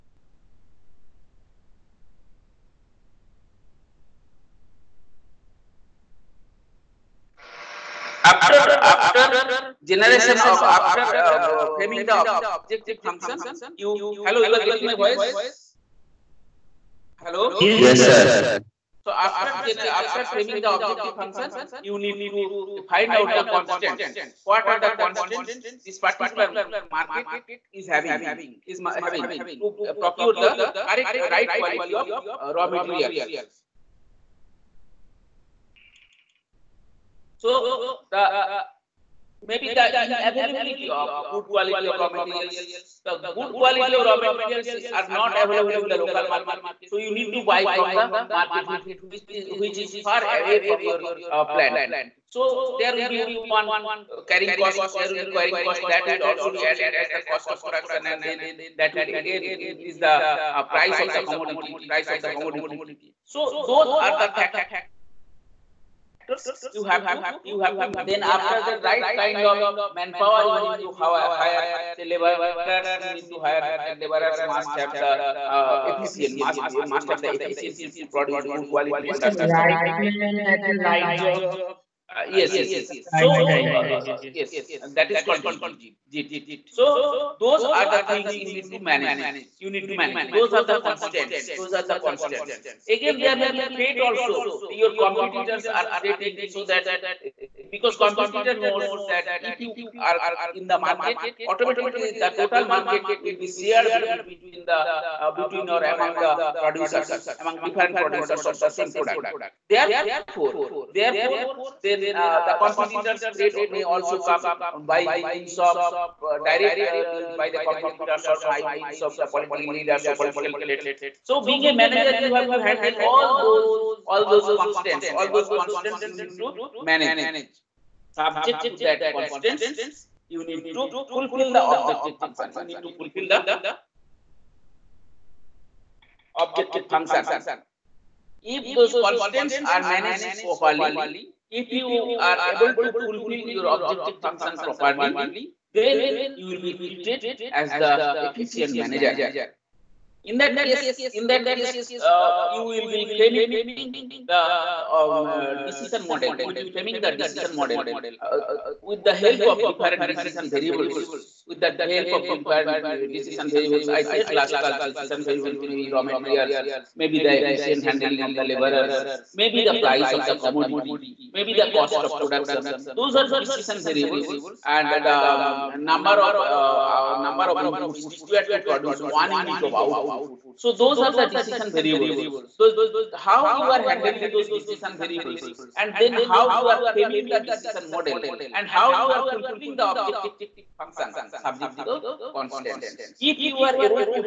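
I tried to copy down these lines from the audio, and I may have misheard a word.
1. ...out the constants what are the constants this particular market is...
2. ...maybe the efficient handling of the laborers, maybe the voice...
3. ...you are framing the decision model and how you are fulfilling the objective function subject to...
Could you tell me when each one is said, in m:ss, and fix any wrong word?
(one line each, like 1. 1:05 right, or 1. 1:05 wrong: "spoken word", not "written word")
1. 0:23 right
2. 2:46 wrong: "price", not "voice"
3. 3:06 right.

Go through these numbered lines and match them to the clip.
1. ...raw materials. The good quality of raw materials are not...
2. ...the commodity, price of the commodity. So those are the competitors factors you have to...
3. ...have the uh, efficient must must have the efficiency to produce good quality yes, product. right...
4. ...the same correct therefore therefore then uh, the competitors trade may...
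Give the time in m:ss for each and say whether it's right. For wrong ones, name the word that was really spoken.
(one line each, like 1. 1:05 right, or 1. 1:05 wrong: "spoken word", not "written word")
1. 0:41 right
2. 1:01 wrong: "factors", not "competitors"
3. 1:14 right
4. 1:48 wrong: "product", not "correct".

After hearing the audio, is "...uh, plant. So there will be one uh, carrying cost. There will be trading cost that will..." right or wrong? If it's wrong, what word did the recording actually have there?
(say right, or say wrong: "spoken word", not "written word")
wrong: "carrying", not "trading".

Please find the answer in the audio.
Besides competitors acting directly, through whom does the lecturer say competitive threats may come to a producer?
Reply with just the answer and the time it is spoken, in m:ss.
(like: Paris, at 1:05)
Political leaders, at 1:59.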